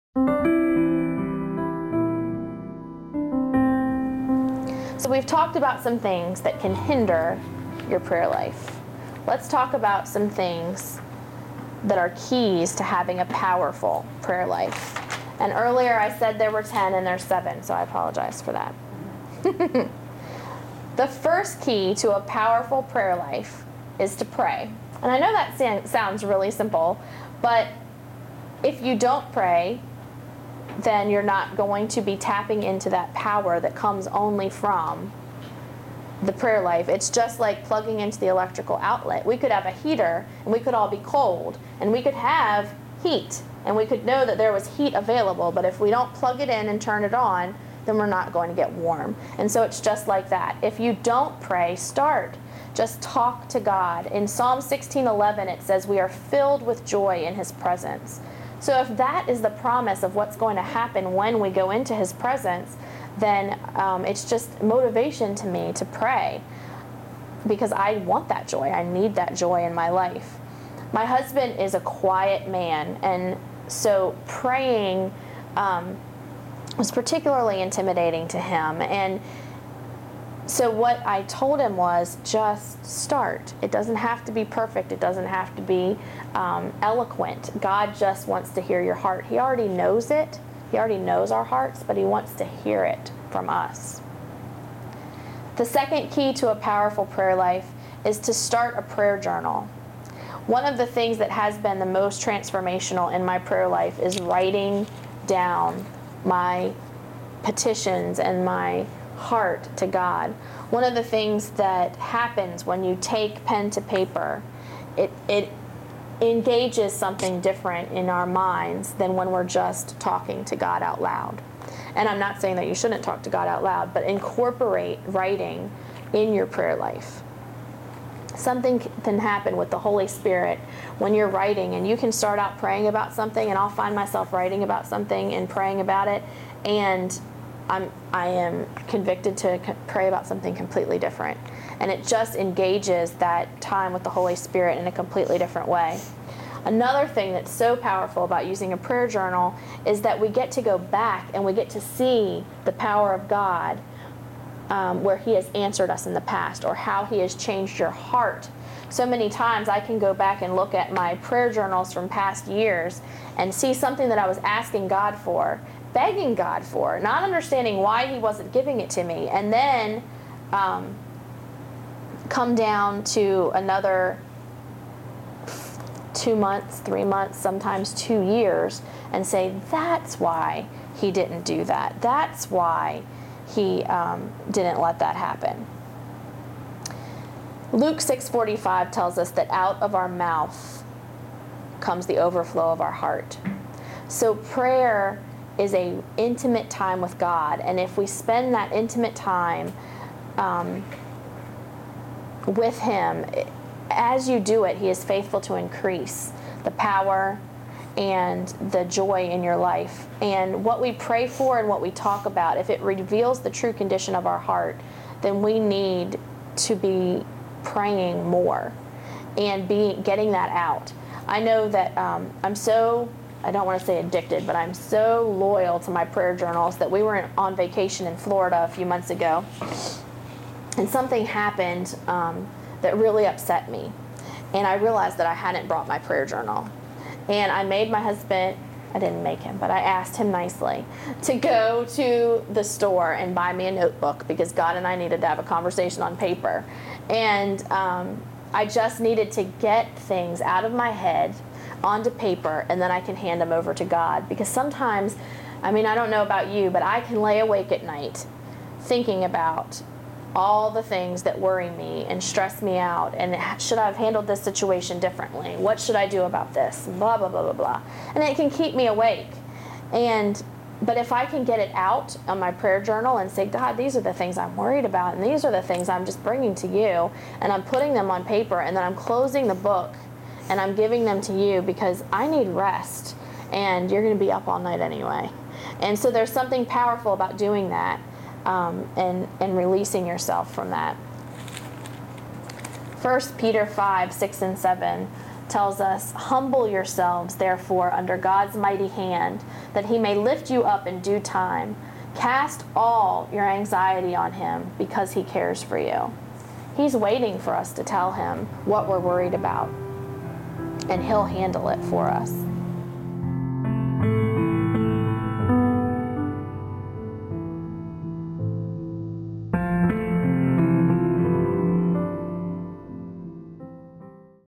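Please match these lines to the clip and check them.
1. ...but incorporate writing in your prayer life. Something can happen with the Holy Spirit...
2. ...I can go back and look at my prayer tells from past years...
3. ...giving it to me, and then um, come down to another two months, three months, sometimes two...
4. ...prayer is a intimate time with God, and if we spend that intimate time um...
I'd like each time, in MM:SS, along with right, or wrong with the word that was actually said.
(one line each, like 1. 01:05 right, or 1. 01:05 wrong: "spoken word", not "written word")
1. 02:03 right
2. 02:39 wrong: "journals", not "tells"
3. 02:48 right
4. 03:14 right.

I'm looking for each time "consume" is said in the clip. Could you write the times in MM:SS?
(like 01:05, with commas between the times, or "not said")
not said.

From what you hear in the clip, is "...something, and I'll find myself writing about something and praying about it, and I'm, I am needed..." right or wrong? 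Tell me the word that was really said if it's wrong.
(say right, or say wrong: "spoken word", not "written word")
wrong: "convicted", not "needed".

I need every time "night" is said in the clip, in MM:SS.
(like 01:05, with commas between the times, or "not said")
04:17, 04:44.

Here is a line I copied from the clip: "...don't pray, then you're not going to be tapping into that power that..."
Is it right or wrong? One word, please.
right.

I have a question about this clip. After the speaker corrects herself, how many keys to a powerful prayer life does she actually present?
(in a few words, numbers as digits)
7.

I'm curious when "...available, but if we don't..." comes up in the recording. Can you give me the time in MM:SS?
00:44.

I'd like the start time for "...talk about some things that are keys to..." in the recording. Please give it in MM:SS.
00:09.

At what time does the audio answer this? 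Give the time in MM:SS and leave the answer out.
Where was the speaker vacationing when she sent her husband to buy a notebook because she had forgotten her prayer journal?
03:48.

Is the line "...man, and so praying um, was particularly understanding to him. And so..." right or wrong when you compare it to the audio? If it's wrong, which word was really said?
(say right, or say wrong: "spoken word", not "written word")
wrong: "intimidating", not "understanding".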